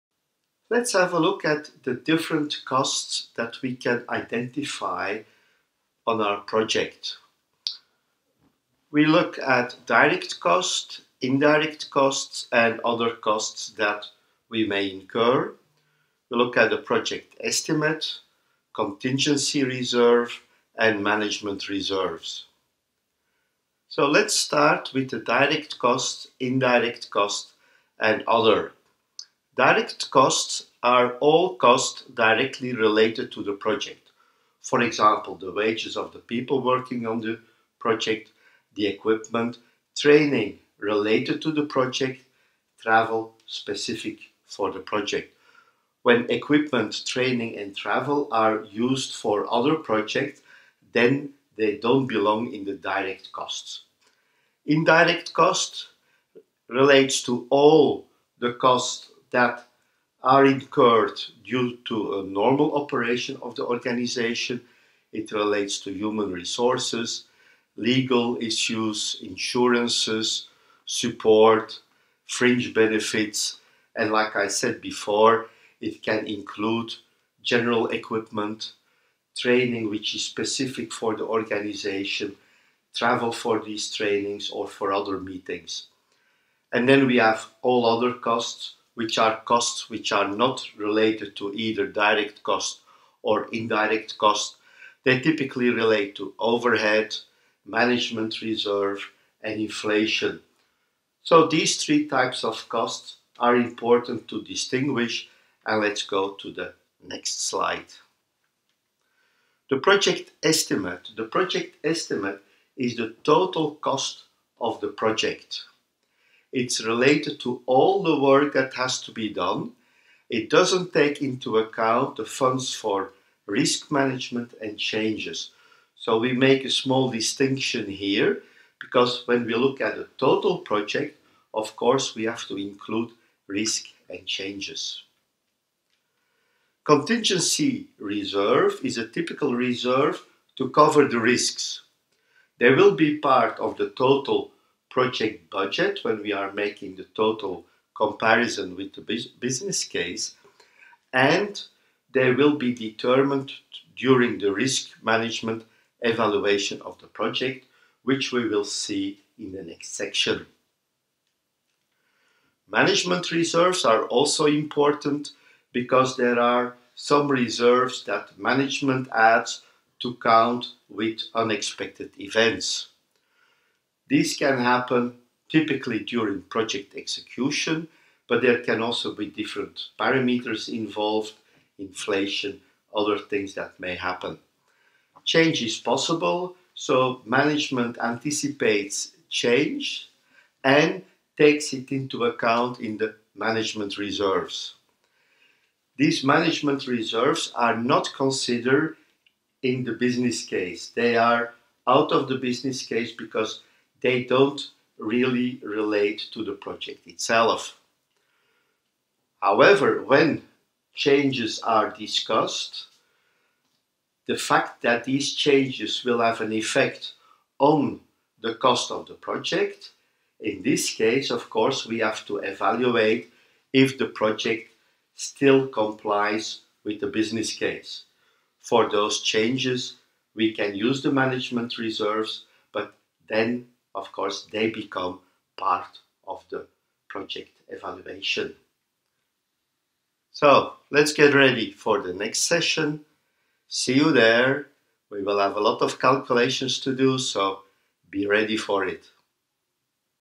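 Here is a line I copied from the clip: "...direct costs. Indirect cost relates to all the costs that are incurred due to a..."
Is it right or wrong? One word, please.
right.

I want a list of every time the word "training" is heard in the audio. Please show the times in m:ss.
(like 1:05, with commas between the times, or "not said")
0:39, 0:47, 1:19, 1:23.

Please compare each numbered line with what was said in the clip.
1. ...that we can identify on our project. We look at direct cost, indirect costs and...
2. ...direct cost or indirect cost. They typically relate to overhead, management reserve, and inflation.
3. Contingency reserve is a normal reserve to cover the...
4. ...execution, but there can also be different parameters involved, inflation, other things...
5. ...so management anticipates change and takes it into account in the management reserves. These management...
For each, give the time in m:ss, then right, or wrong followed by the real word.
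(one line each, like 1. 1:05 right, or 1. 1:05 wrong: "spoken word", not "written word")
1. 0:03 right
2. 1:31 right
3. 2:16 wrong: "typical", not "normal"
4. 2:56 right
5. 3:06 right.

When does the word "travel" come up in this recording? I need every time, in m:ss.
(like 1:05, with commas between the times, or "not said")
0:42, 0:47, 1:22.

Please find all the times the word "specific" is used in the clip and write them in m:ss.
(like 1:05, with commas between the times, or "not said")
0:43, 1:20.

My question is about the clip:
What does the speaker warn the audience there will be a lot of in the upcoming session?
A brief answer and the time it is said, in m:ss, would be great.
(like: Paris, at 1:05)
Calculations, at 4:05.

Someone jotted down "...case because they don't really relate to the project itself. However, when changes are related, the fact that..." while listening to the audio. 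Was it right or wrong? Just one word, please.
wrong.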